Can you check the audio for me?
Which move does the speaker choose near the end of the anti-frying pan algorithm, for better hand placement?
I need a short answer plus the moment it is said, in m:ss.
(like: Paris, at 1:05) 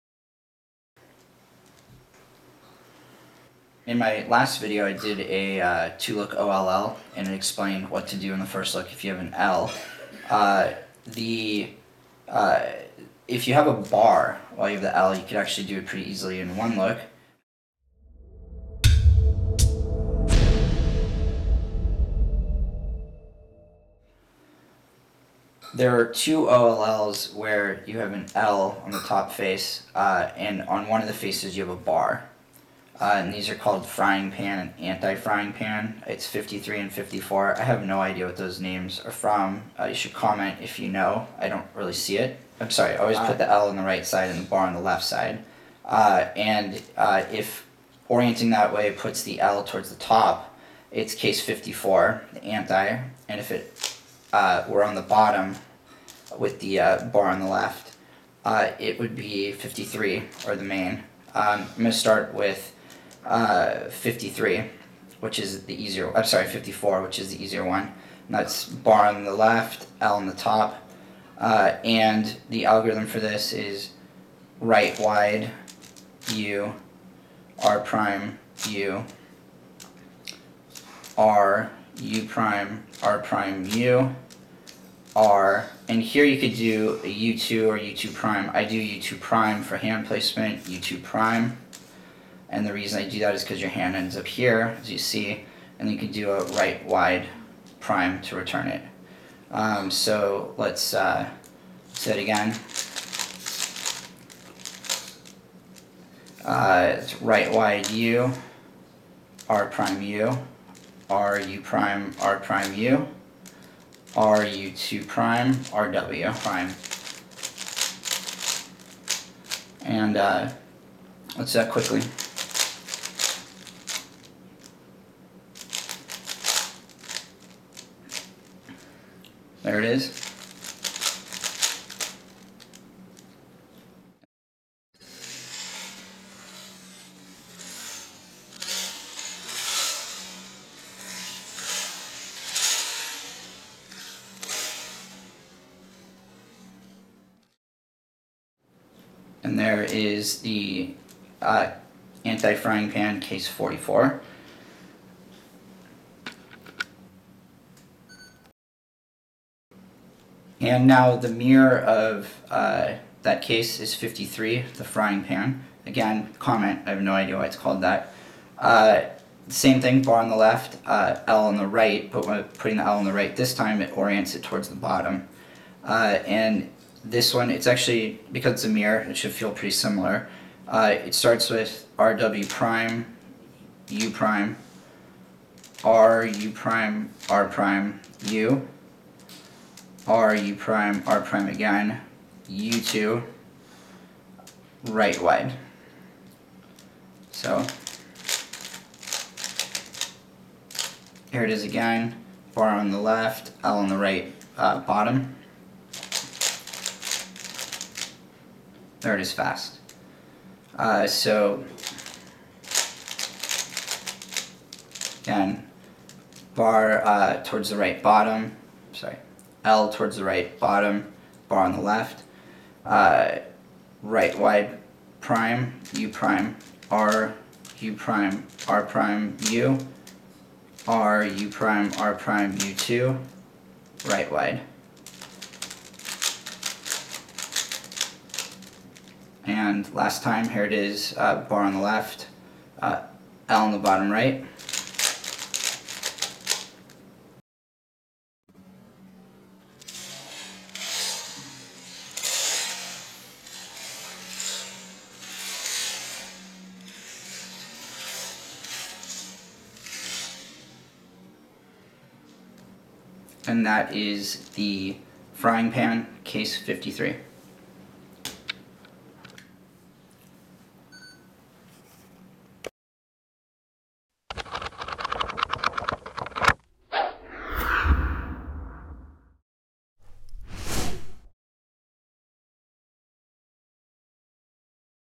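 U2 prime, at 1:28.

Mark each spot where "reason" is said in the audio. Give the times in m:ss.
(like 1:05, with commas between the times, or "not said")
1:32.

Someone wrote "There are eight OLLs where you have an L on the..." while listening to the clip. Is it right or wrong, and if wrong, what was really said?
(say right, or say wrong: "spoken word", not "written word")
wrong: "two", not "eight".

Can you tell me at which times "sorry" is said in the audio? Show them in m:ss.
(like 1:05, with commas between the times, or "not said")
0:42, 1:06, 3:38.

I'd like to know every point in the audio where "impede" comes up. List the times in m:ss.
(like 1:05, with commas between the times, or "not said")
not said.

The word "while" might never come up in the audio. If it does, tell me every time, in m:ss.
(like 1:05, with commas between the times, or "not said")
0:14.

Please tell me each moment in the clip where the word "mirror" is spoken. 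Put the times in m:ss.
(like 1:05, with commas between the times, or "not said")
2:41, 2:58.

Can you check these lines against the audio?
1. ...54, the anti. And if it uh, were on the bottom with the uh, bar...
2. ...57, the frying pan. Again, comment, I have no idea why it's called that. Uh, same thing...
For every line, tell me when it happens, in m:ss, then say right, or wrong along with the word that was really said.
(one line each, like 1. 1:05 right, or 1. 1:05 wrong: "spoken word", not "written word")
1. 0:51 right
2. 2:43 wrong: "53", not "57".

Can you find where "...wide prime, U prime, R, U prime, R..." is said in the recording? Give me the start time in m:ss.
3:44.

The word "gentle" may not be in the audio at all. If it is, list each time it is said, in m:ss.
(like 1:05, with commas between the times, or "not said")
not said.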